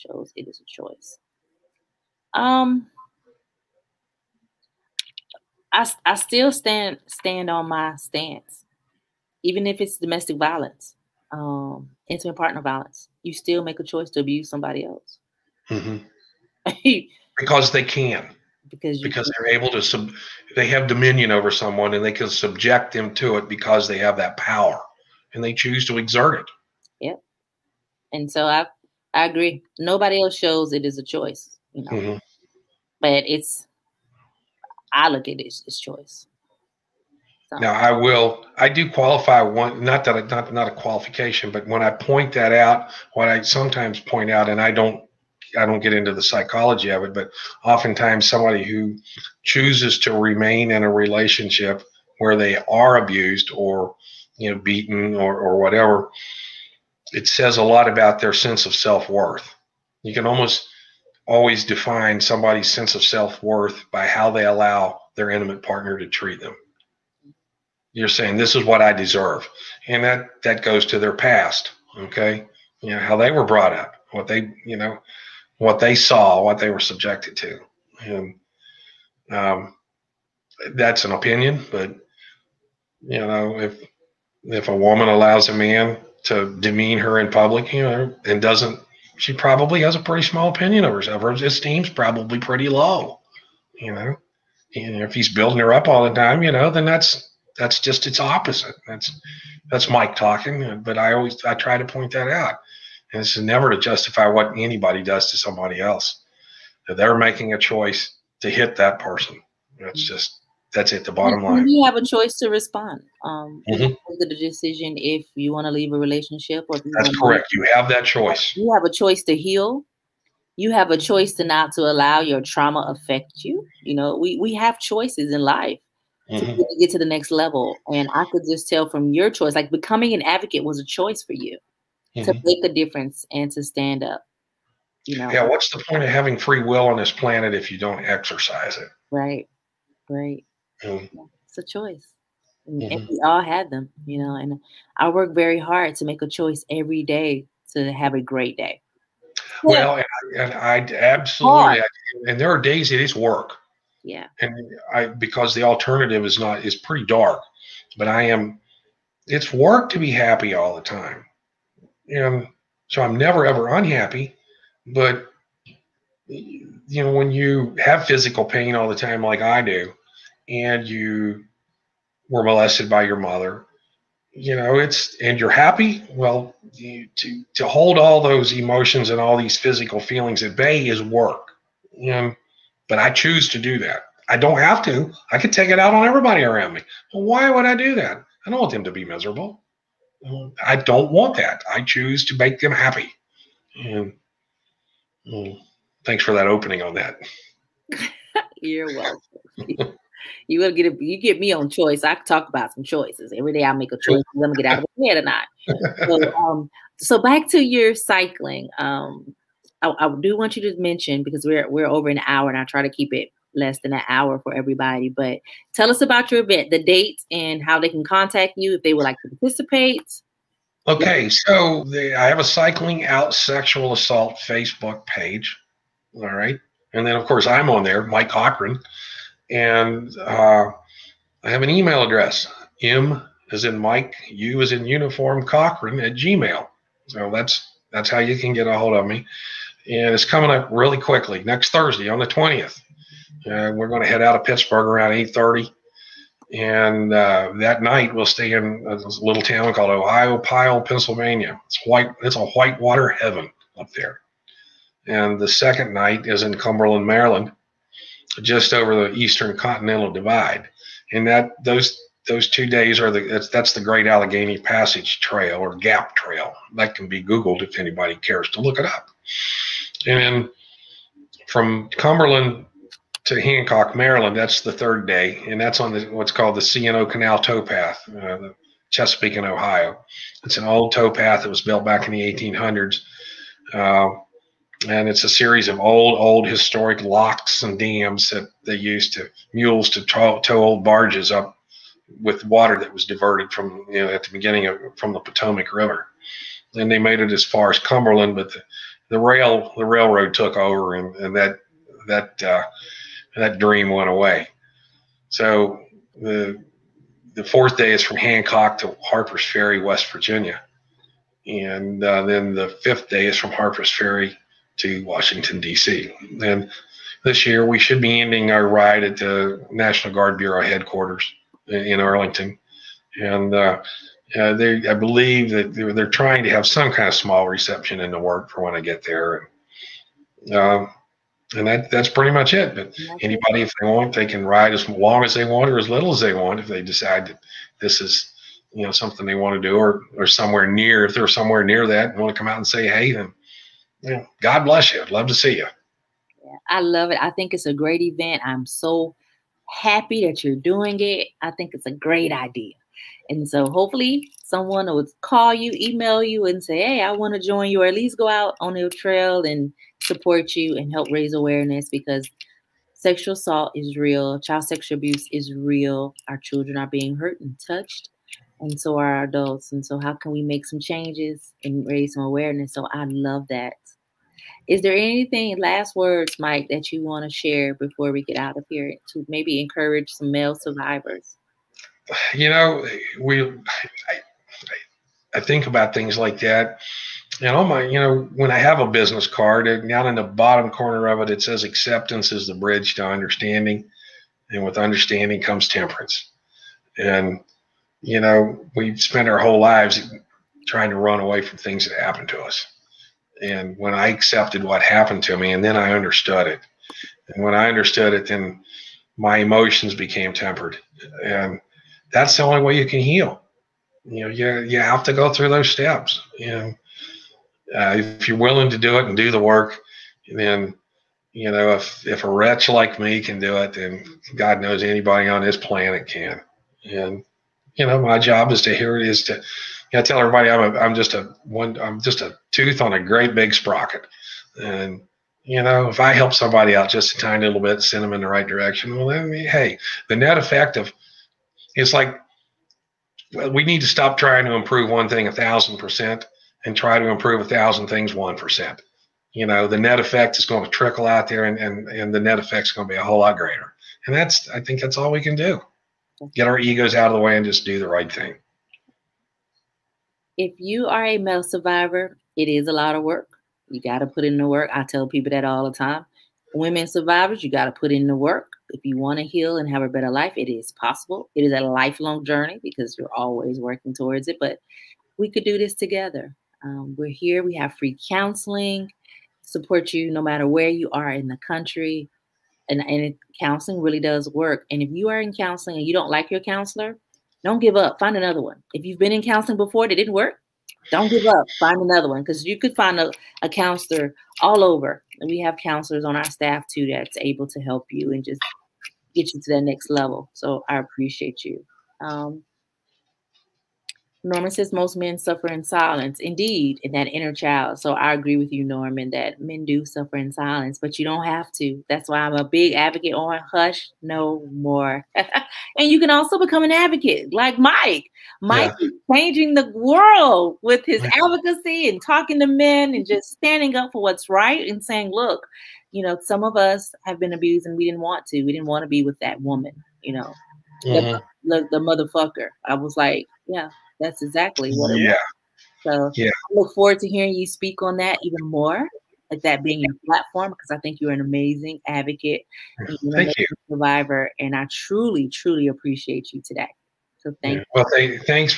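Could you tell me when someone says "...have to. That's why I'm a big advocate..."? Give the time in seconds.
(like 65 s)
511 s.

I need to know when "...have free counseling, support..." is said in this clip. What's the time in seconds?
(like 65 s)
477 s.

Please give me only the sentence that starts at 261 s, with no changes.
And that those those two days are the that's, that's the Great Allegheny Passage Trail or Gap Trail.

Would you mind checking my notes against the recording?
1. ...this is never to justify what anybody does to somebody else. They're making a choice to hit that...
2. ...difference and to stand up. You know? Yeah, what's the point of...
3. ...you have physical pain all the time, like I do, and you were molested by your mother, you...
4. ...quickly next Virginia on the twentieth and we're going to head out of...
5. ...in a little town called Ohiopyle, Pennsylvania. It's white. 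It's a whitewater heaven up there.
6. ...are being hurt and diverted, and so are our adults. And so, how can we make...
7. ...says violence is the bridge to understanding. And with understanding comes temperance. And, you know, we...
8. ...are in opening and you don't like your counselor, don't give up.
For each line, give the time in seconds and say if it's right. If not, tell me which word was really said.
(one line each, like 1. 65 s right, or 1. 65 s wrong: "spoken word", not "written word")
1. 103 s right
2. 132 s right
3. 167 s right
4. 241 s wrong: "Thursday", not "Virginia"
5. 248 s right
6. 366 s wrong: "touched", not "diverted"
7. 391 s wrong: "acceptance", not "violence"
8. 485 s wrong: "counseling", not "opening".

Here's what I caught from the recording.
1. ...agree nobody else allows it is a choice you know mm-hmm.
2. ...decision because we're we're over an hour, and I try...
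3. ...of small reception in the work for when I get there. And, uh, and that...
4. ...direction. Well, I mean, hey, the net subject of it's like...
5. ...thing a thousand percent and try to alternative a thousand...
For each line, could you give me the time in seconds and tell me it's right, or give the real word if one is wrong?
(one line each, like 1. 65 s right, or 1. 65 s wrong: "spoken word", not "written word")
1. 29 s wrong: "shows", not "allows"
2. 210 s wrong: "mention", not "decision"
3. 327 s right
4. 438 s wrong: "effect", not "subject"
5. 445 s wrong: "improve", not "alternative".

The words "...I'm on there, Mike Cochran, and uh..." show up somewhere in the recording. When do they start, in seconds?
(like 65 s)
227 s.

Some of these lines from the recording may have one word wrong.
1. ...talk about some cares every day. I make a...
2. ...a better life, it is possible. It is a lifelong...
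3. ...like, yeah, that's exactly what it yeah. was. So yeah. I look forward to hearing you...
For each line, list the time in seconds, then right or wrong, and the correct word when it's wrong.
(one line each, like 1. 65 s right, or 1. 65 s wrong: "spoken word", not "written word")
1. 202 s wrong: "choices", not "cares"
2. 469 s right
3. 532 s right.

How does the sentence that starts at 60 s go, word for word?
You can almost always define somebody's sense of self worth by how they allow their intimate partner to treat them.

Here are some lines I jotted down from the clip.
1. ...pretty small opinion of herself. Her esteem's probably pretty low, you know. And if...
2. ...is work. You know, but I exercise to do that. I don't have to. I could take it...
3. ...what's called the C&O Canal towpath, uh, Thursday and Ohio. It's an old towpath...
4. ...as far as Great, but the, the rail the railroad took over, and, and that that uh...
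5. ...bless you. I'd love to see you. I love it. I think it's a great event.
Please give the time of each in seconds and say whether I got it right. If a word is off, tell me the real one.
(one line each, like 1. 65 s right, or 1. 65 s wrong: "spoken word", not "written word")
1. 89 s right
2. 180 s wrong: "choose", not "exercise"
3. 276 s wrong: "Chesapeake", not "Thursday"
4. 297 s wrong: "Cumberland", not "Great"
5. 344 s right.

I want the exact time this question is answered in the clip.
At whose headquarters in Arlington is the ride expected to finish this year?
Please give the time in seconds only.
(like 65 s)
319 s.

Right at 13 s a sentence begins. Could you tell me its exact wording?
You still make a choice to abuse somebody else mm-hmm.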